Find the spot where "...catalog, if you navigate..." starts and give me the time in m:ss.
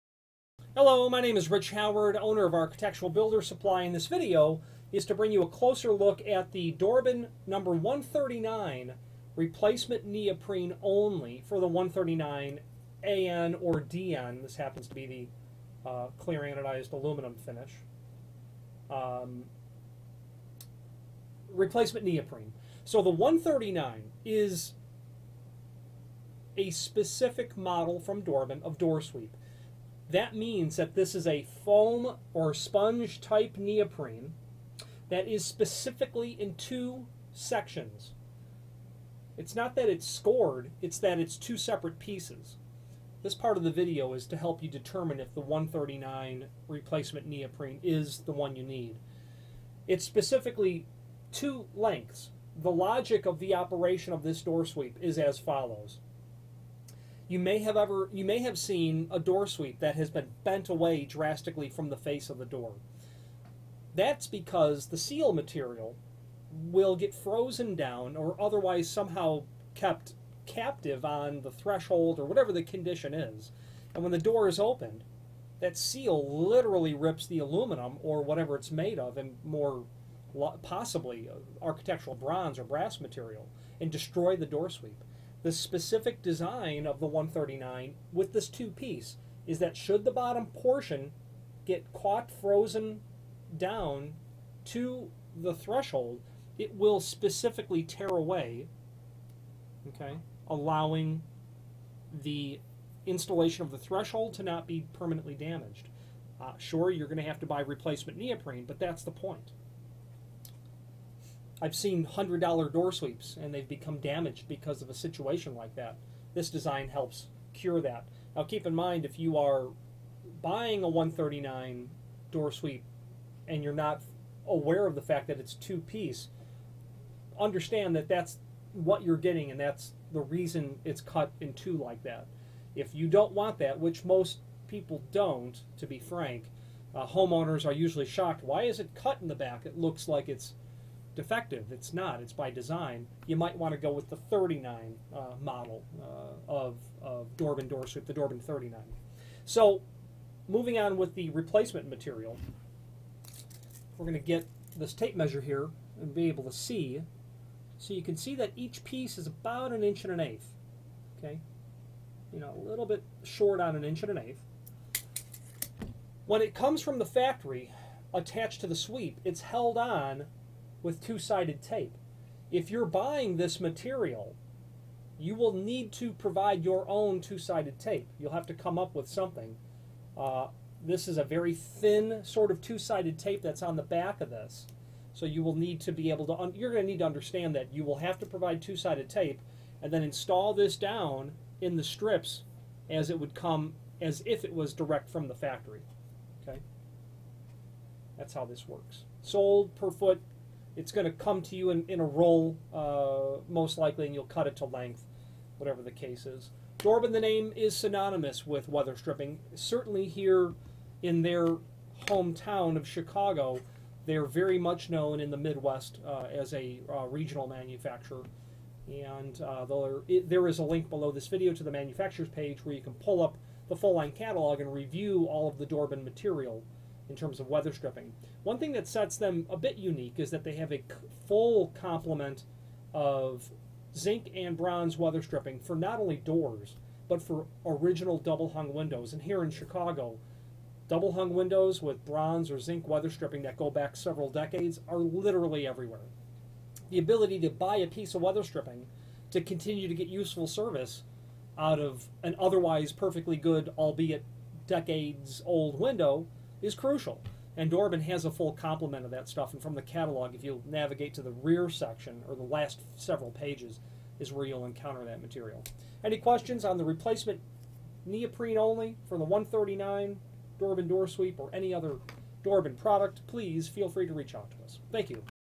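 4:19.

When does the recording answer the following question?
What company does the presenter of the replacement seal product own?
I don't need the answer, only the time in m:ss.
0:02.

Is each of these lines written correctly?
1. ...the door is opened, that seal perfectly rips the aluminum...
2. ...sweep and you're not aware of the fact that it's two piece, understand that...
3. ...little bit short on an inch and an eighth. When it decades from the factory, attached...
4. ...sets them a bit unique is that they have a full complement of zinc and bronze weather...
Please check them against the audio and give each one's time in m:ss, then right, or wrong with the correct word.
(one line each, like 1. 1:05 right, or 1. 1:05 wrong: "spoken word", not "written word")
1. 1:14 wrong: "literally", not "perfectly"
2. 2:02 right
3. 2:42 wrong: "comes", not "decades"
4. 3:48 right.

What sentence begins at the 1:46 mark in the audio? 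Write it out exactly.
Uh, sure, you're going to have to buy replacement neoprene, but that's the point.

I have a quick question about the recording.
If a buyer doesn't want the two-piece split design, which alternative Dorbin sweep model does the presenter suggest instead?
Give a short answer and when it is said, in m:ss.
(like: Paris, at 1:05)
Dorbin 39, at 2:28.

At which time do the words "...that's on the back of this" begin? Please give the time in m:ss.
3:03.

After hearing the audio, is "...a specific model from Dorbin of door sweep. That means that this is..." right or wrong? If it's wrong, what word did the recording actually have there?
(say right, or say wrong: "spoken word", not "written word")
right.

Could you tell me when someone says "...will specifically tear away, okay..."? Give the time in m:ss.
1:36.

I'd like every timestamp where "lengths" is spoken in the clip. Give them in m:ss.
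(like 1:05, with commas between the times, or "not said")
0:51, 3:24.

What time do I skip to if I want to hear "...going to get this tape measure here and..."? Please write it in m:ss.
2:34.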